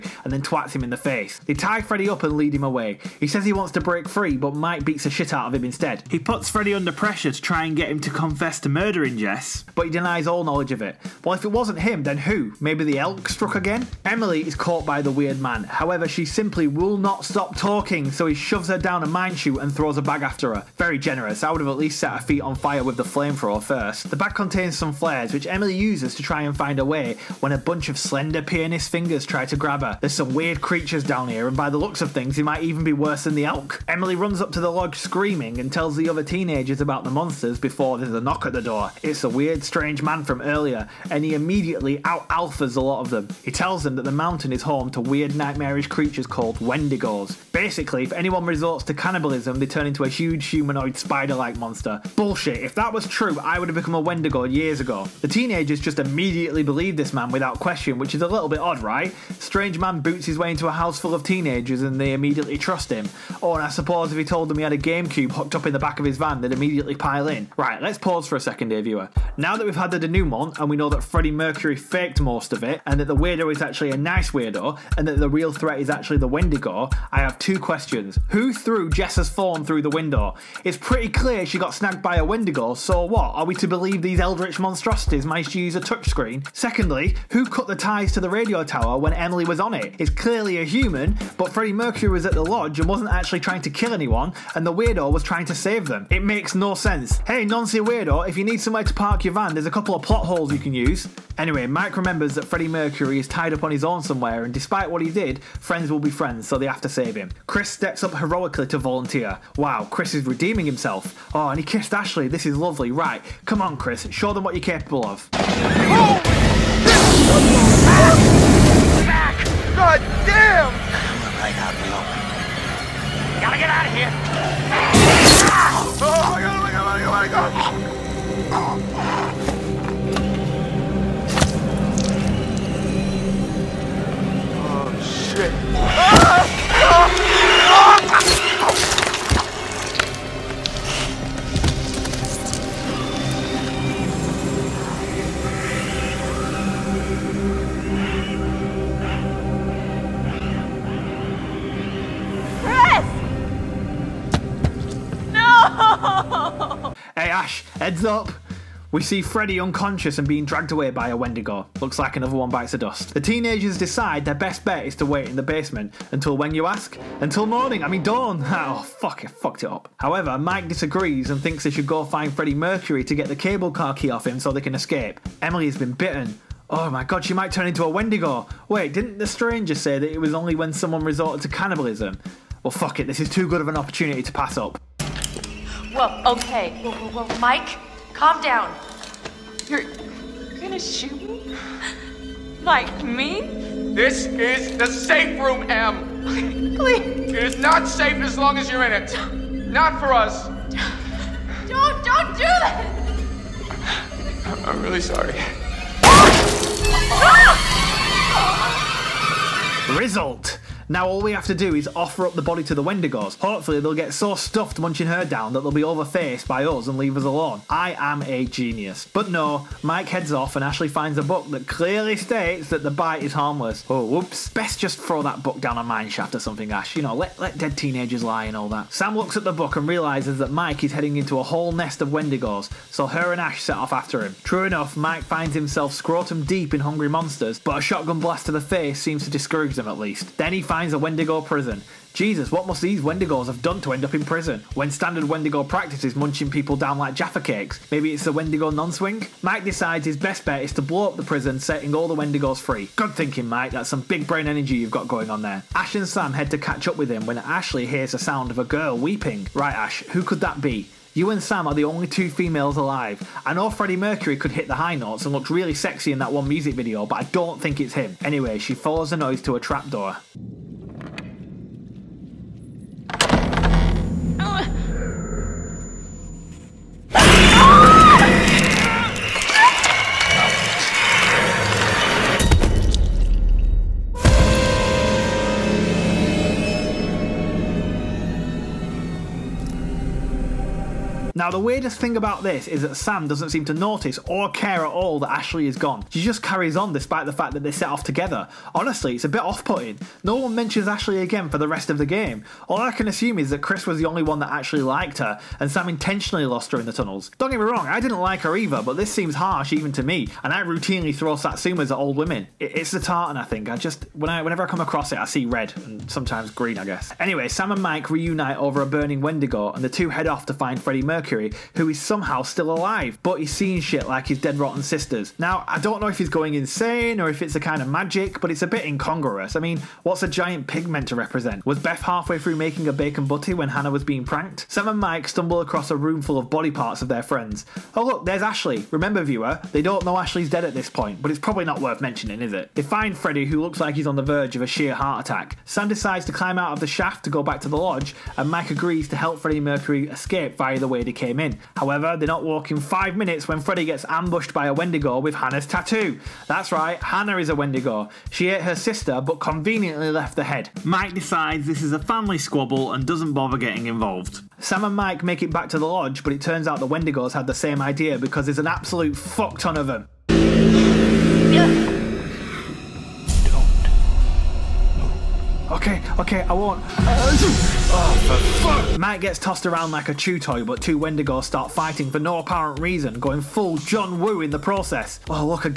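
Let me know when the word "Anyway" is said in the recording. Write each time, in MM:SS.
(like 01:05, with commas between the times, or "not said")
01:41, 04:28, 05:17.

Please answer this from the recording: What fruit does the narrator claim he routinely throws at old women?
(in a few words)
Satsumas.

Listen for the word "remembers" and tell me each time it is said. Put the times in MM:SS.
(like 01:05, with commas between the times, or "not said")
01:41, 05:38.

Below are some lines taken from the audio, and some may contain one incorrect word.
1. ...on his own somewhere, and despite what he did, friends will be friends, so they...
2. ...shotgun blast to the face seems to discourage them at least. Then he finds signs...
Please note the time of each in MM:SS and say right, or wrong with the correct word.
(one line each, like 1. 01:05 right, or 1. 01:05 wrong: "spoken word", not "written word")
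1. 01:43 right
2. 03:57 right.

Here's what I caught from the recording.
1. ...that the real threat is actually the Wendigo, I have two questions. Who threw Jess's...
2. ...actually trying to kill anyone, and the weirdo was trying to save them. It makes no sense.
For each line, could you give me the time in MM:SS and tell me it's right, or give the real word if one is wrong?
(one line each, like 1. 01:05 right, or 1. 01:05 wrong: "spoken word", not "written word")
1. 01:15 right
2. 01:33 right.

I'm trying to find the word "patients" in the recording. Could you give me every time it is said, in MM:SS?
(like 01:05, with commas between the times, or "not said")
not said.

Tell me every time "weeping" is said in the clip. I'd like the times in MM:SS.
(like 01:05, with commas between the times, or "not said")
04:18.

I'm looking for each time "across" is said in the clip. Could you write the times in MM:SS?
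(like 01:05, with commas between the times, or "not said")
05:14, 05:35.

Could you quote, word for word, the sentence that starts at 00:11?
Well, if it wasn't him, then who?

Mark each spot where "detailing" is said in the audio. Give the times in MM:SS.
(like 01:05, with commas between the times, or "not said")
not said.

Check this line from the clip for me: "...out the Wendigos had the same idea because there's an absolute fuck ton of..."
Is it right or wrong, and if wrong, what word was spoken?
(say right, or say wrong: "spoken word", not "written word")
right.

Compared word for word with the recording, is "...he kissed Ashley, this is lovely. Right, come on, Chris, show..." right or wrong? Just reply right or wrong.
right.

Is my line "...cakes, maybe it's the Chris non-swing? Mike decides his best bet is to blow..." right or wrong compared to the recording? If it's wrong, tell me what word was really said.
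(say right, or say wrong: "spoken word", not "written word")
wrong: "Wendigo", not "Chris".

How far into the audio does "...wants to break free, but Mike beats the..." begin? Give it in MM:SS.
00:03.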